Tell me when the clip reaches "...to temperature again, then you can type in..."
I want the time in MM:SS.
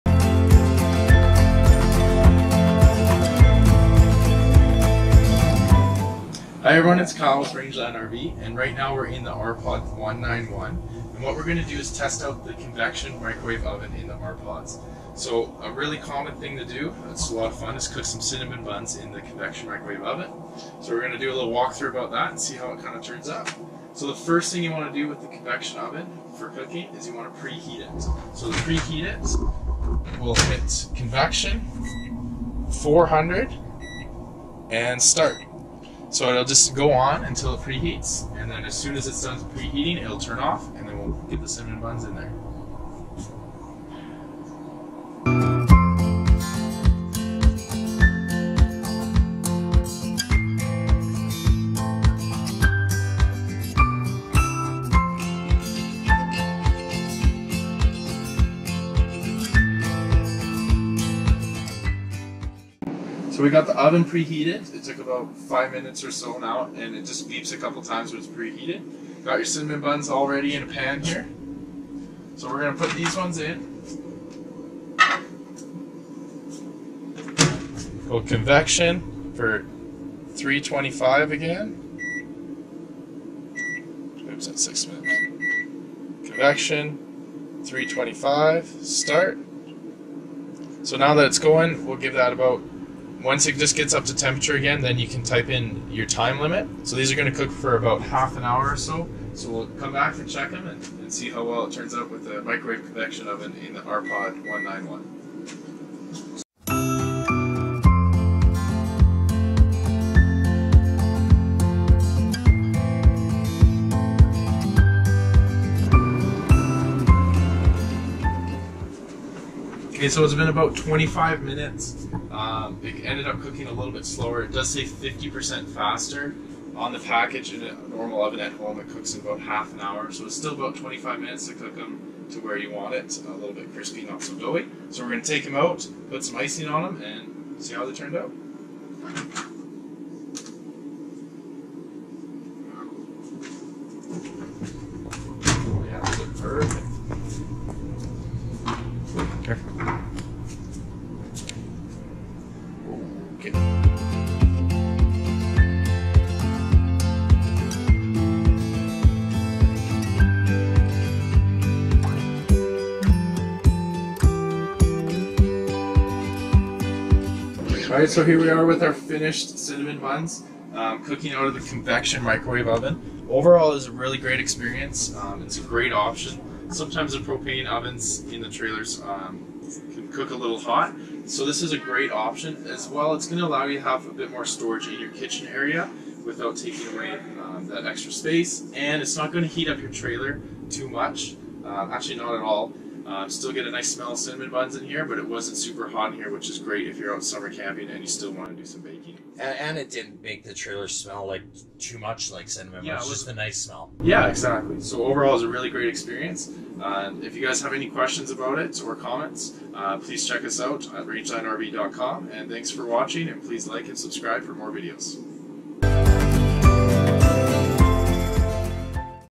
01:34.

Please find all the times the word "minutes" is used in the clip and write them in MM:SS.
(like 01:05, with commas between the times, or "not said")
01:05, 01:24, 02:01, 02:11.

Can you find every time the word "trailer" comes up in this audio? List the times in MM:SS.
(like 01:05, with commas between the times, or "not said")
02:58, 03:09, 03:20.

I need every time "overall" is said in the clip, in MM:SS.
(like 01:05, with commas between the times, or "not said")
02:53, 03:25.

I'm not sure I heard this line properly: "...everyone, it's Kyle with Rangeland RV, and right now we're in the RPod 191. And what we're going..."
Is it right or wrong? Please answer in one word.
right.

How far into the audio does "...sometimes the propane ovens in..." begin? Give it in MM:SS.
02:56.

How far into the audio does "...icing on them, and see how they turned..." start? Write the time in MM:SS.
02:16.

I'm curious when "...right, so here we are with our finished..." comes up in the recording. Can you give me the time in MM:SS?
02:47.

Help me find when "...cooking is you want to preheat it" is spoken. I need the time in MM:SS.
00:26.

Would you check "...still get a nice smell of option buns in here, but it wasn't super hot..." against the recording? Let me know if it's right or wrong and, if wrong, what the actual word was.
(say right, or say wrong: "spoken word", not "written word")
wrong: "cinnamon", not "option".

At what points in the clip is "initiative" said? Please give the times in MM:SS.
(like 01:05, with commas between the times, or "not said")
not said.